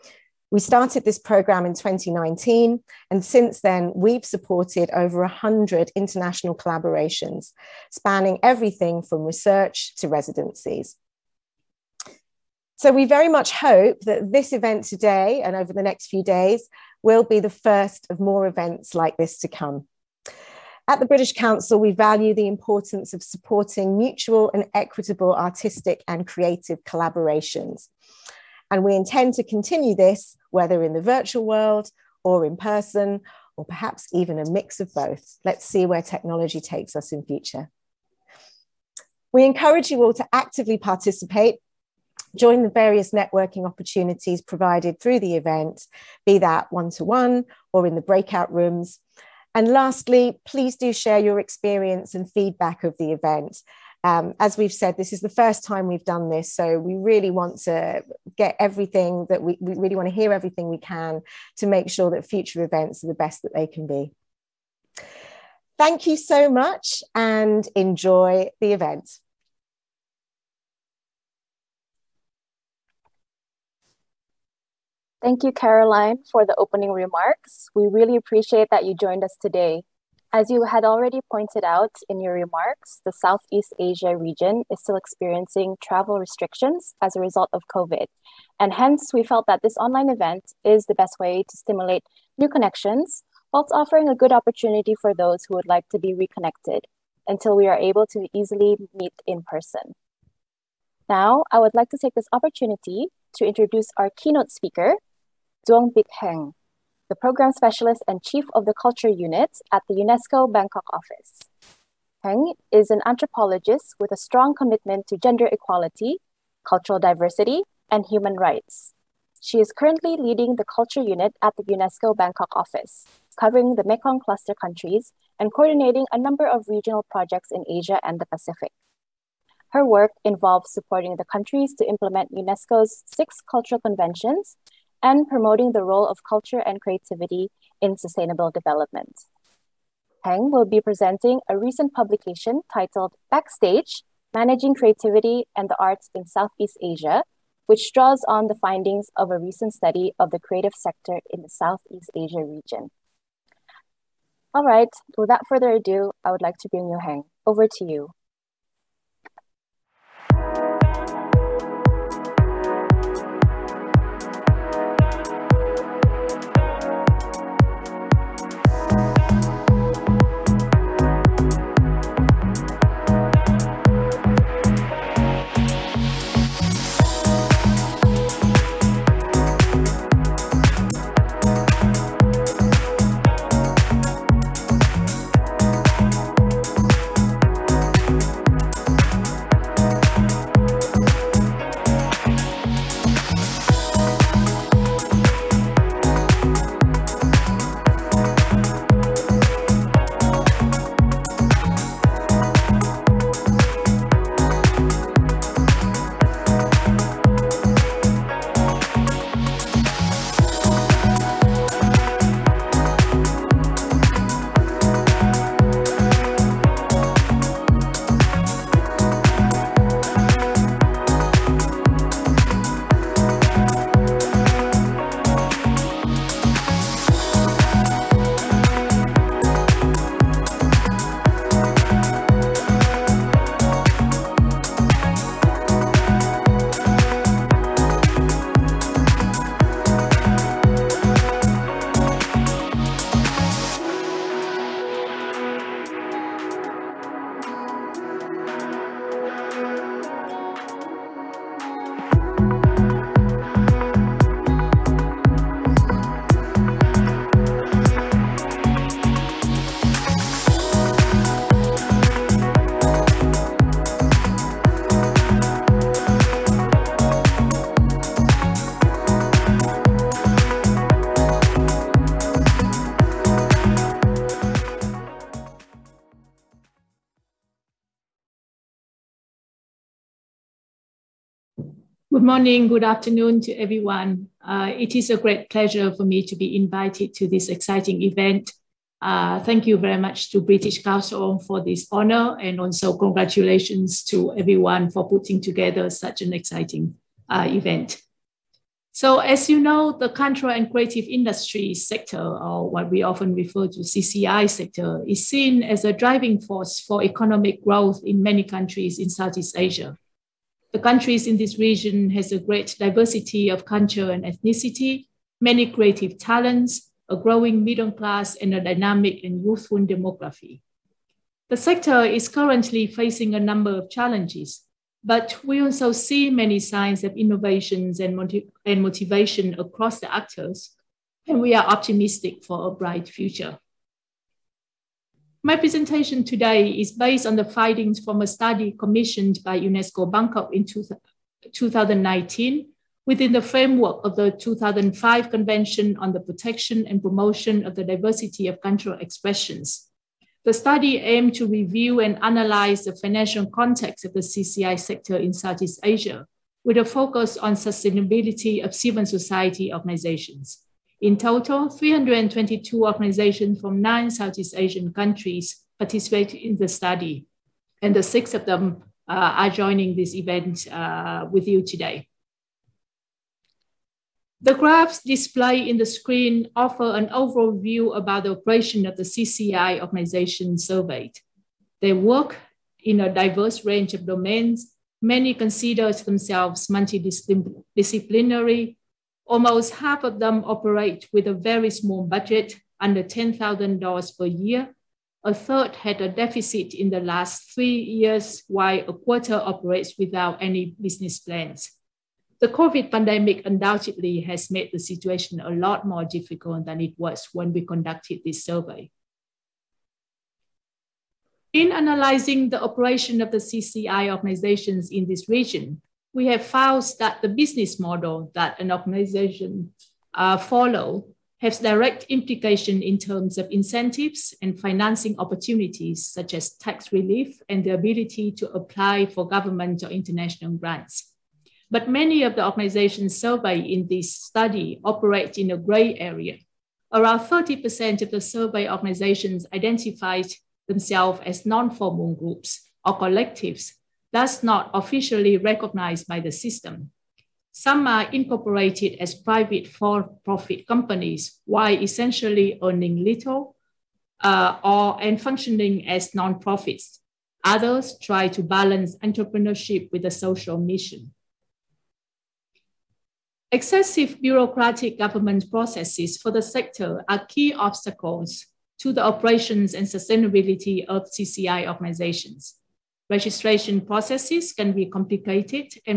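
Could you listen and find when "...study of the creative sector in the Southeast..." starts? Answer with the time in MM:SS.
02:29.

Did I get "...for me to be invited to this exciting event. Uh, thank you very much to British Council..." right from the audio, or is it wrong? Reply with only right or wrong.
right.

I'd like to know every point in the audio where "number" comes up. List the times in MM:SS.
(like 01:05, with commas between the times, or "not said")
02:06, 05:23.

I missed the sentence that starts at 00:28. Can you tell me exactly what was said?
And we intend to continue this, whether in the virtual world or in person, or perhaps even a mix of both.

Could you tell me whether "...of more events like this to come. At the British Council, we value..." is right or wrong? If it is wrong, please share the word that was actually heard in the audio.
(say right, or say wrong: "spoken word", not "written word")
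right.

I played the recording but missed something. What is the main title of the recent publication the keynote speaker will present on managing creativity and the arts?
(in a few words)
Backstage.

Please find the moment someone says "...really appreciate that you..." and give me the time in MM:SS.
01:17.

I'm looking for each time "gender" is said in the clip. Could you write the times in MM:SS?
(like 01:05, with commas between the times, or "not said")
01:55.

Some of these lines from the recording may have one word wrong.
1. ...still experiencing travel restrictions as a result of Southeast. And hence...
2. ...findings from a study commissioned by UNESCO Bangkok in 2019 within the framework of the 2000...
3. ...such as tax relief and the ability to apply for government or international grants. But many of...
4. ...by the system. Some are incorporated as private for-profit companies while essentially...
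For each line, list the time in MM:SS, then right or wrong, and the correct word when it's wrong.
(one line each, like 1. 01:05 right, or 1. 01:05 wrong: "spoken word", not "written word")
1. 01:24 wrong: "COVID", not "Southeast"
2. 05:37 wrong: "2005", not "2000"
3. 07:06 right
4. 07:26 right.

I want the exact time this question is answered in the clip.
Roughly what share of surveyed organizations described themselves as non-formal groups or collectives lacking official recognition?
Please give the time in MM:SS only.
07:17.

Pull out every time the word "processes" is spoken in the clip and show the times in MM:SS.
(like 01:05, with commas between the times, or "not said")
07:45, 07:53.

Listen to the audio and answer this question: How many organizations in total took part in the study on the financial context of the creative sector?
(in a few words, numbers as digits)
322.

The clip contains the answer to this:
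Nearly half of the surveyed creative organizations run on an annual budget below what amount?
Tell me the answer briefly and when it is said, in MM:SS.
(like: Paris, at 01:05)
$10,000, at 06:33.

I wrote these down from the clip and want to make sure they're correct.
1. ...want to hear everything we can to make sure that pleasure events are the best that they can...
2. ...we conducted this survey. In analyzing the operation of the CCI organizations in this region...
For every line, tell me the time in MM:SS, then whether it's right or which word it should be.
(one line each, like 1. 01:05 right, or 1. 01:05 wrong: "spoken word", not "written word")
1. 00:59 wrong: "future", not "pleasure"
2. 06:47 right.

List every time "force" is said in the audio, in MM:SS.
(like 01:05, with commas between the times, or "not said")
05:06.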